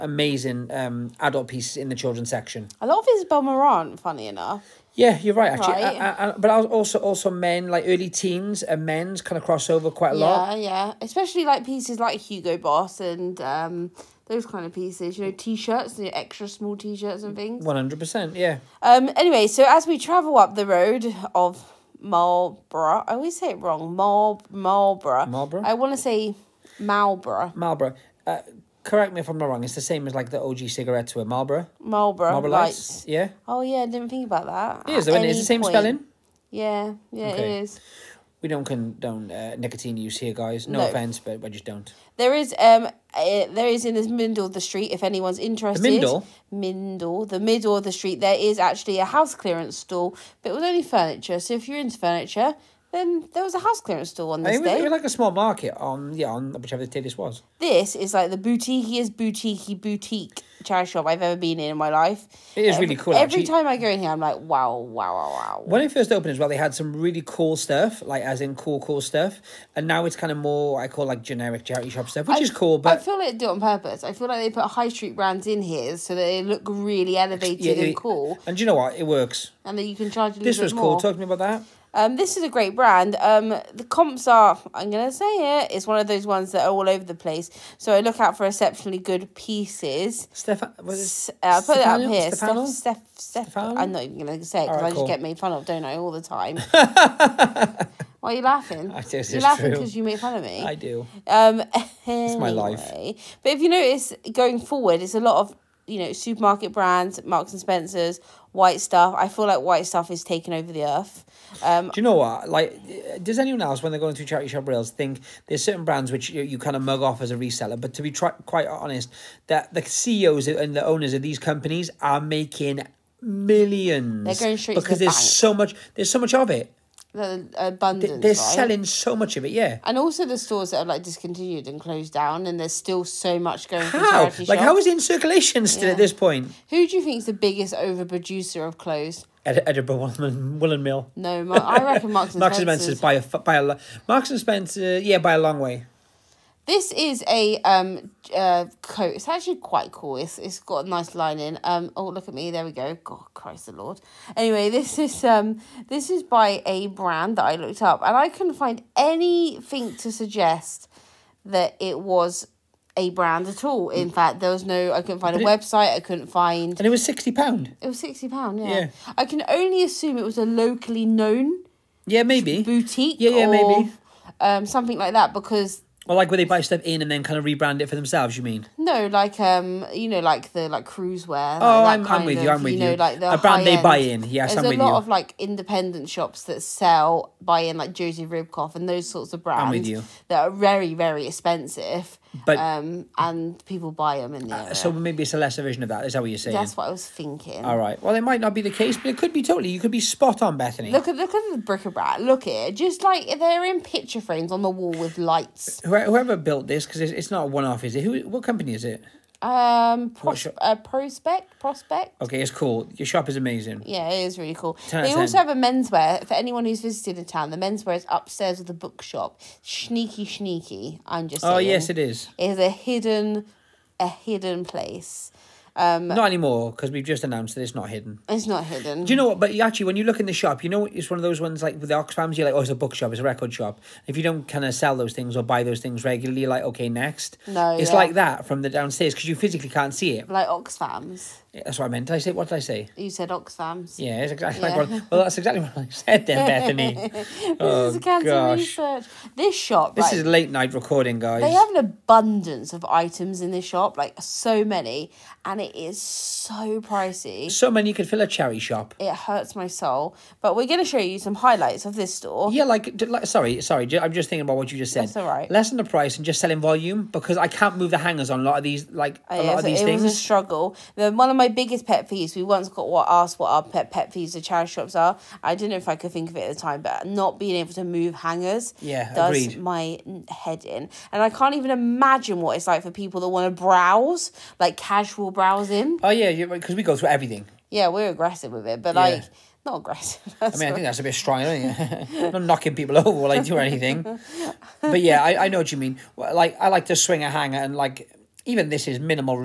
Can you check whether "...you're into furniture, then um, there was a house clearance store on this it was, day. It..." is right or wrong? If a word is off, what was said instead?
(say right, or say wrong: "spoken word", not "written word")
right.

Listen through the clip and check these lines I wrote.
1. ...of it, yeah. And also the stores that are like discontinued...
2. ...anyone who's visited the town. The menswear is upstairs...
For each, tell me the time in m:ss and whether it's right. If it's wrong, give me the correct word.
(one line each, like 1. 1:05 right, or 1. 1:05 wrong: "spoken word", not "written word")
1. 2:09 right
2. 3:36 right.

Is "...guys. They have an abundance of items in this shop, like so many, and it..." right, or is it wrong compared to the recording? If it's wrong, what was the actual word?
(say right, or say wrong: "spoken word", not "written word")
right.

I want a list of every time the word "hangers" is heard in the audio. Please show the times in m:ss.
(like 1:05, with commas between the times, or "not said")
4:27, 4:38, 4:57.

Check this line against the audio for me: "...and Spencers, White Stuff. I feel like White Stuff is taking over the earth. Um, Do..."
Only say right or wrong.
right.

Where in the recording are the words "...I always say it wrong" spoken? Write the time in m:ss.
0:23.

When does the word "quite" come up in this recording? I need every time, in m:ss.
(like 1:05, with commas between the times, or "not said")
0:09, 1:58, 2:29.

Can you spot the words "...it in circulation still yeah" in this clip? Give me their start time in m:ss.
2:14.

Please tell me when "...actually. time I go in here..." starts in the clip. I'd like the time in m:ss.
1:03.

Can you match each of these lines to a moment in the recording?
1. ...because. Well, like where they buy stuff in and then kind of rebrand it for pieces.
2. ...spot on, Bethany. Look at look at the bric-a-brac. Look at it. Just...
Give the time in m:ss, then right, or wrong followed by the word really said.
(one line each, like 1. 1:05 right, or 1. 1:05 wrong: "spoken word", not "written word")
1. 2:55 wrong: "themselves", not "pieces"
2. 3:20 right.